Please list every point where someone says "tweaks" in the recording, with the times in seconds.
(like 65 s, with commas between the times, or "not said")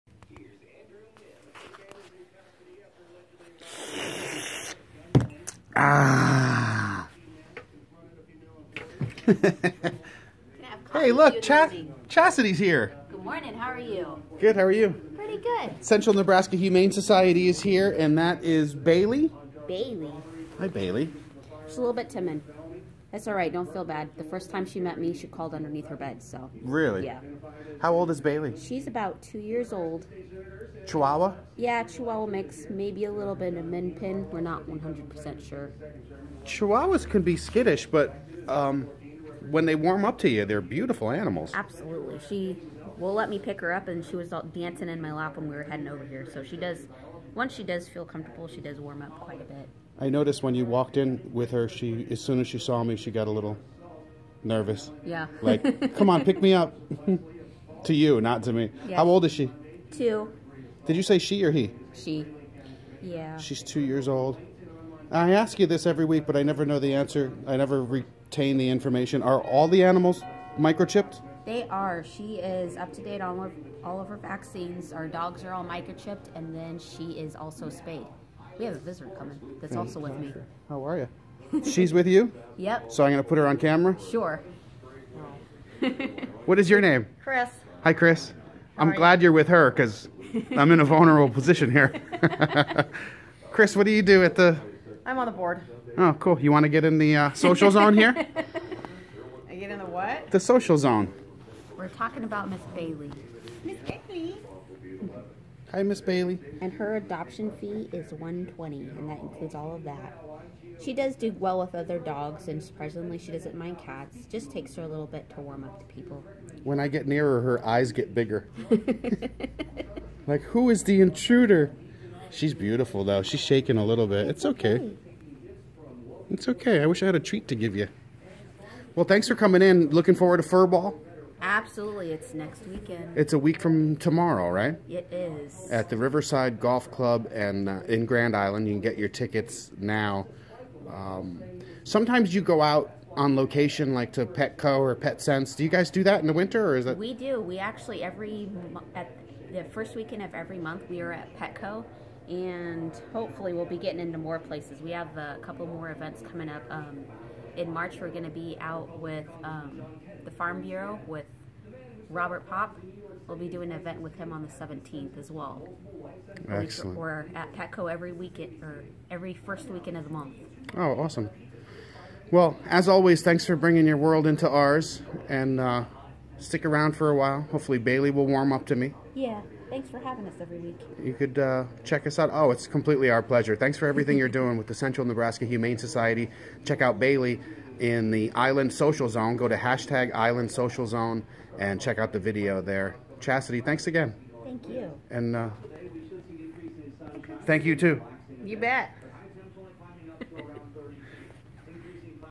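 not said.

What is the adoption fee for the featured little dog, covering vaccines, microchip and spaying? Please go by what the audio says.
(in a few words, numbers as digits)
$120.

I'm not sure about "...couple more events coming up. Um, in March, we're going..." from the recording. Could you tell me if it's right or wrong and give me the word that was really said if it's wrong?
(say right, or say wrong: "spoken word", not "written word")
right.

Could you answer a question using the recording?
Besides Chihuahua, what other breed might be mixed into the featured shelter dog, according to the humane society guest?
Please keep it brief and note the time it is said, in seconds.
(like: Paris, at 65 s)
min pin, at 33 s.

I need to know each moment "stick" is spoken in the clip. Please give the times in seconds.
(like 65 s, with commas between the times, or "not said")
176 s.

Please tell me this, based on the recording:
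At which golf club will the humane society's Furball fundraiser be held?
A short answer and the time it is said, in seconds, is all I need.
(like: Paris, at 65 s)
Riverside Golf Club, at 135 s.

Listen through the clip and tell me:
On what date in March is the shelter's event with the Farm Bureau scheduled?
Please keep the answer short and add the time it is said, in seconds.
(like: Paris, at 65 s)
17th, at 164 s.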